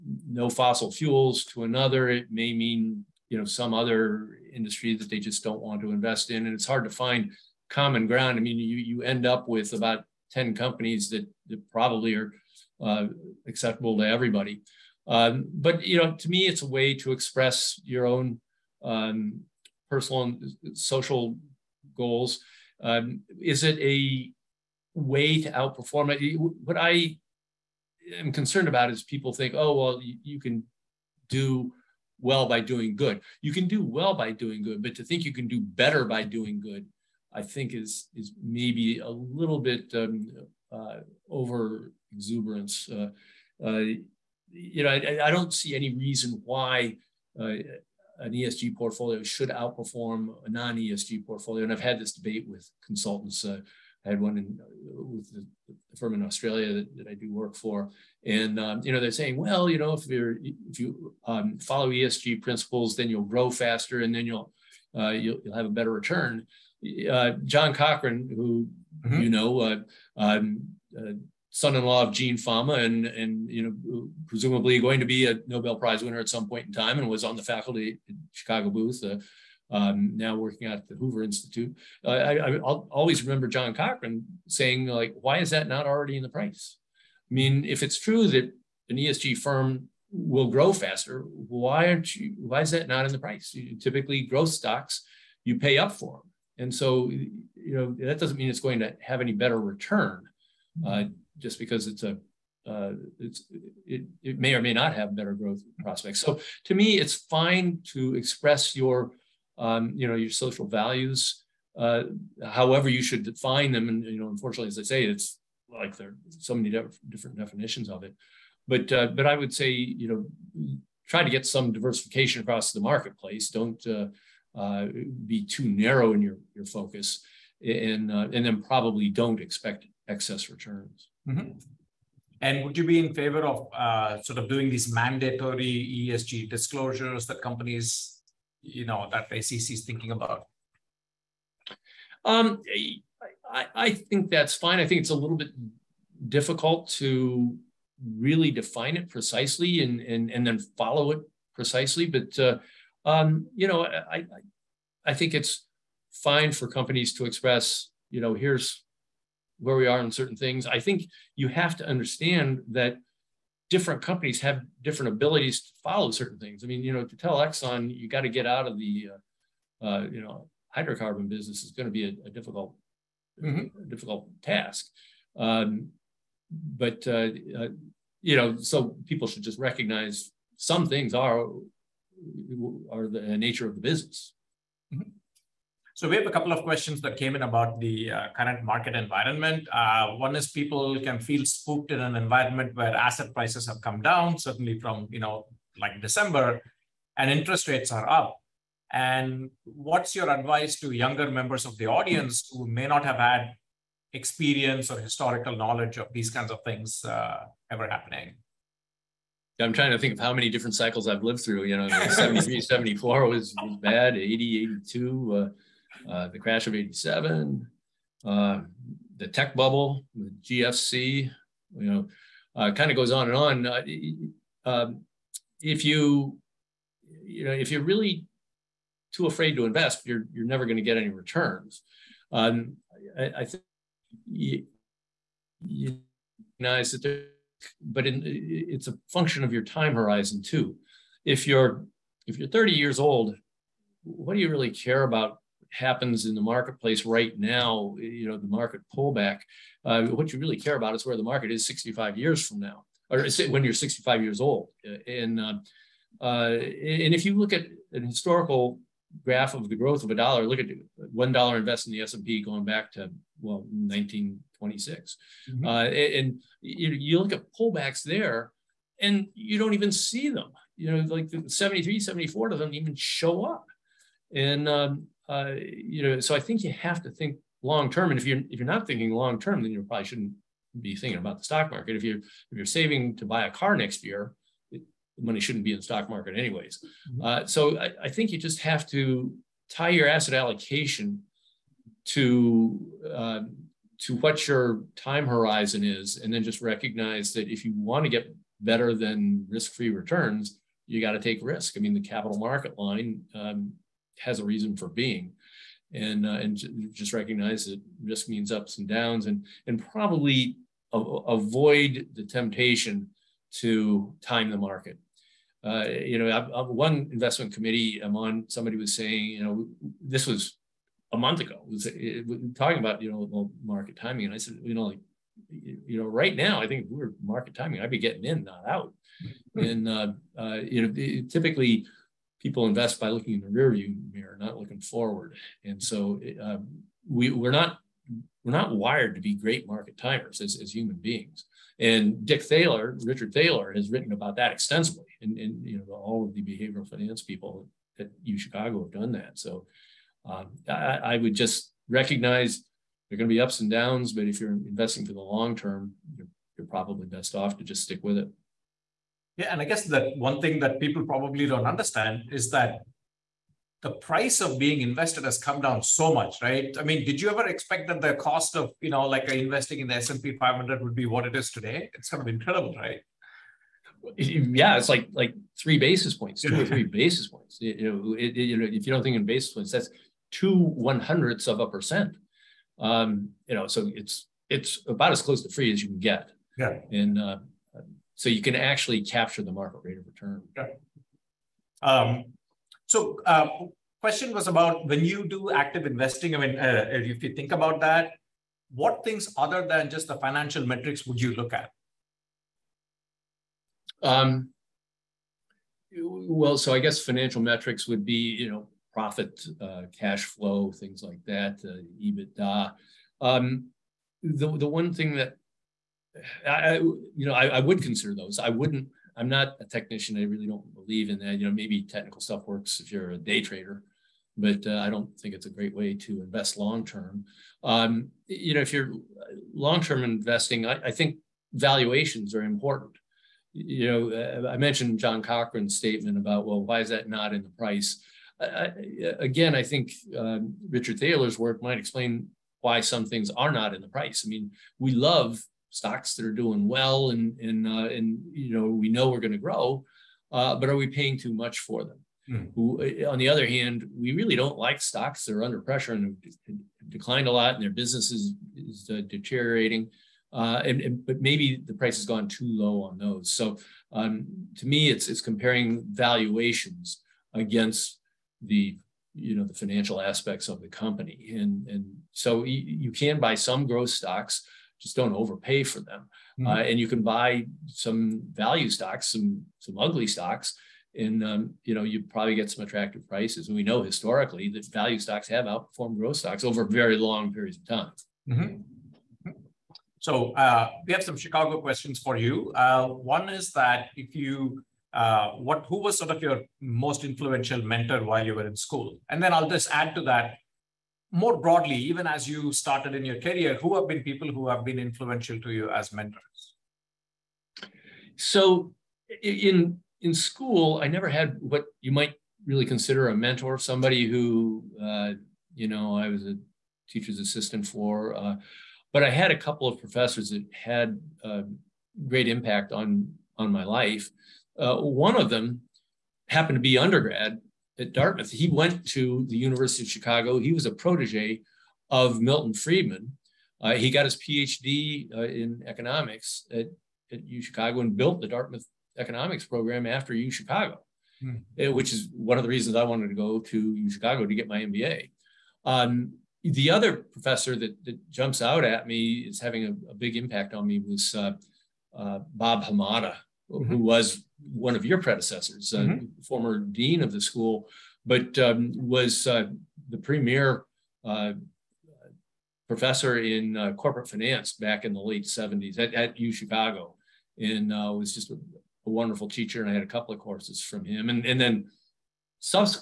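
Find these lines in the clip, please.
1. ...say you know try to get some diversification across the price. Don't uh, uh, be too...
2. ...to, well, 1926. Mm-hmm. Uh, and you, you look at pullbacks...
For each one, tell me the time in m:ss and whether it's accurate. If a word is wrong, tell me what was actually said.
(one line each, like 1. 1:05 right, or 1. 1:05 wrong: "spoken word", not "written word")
1. 1:59 wrong: "marketplace", not "price"
2. 4:22 right.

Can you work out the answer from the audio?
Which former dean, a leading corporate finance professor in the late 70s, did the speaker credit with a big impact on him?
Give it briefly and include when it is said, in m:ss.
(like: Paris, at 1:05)
Bob Hamada, at 9:12.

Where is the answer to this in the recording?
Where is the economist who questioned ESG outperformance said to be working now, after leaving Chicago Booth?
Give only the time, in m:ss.
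1:20.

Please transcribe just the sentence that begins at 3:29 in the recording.
I'm trying to think of how many different cycles I've lived through.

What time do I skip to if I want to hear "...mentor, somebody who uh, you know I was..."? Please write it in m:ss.
8:33.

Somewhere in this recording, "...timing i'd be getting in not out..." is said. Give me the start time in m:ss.
5:27.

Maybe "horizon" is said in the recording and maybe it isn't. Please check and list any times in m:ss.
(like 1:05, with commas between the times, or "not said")
3:59, 4:55.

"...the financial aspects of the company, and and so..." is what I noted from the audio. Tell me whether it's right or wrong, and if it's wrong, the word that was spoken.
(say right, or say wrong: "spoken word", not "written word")
right.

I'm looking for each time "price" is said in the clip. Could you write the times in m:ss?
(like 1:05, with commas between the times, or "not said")
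1:26, 1:33, 3:13, 6:03, 7:17, 7:23, 7:41, 8:03.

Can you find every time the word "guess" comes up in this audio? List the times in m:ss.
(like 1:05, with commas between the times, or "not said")
5:59, 6:46.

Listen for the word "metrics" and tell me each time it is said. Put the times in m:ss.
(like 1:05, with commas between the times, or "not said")
6:40, 6:47.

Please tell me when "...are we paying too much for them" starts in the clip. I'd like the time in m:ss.
7:30.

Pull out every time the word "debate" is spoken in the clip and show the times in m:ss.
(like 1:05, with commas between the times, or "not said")
0:52.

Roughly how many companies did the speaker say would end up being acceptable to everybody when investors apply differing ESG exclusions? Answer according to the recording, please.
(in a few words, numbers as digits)
10.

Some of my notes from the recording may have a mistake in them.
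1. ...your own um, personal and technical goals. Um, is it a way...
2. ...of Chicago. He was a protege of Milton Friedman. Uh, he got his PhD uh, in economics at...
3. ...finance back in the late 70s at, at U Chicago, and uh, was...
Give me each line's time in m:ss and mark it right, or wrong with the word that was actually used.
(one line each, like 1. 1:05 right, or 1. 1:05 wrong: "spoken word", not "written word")
1. 0:17 wrong: "social", not "technical"
2. 8:49 right
3. 9:24 right.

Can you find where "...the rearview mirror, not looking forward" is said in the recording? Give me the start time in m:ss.
5:33.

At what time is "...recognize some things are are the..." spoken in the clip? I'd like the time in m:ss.
2:59.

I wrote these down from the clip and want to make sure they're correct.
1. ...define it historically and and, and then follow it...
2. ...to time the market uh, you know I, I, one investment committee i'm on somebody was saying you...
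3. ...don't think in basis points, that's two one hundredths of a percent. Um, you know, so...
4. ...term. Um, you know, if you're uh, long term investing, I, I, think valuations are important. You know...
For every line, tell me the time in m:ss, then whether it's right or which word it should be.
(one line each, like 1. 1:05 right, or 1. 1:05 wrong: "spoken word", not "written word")
1. 2:28 wrong: "precisely", not "historically"
2. 5:13 right
3. 6:18 right
4. 7:06 right.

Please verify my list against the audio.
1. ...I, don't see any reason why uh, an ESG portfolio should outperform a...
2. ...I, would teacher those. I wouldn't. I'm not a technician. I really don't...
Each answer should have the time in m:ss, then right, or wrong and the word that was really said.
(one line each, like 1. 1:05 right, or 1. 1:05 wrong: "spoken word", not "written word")
1. 0:45 right
2. 6:57 wrong: "consider", not "teacher".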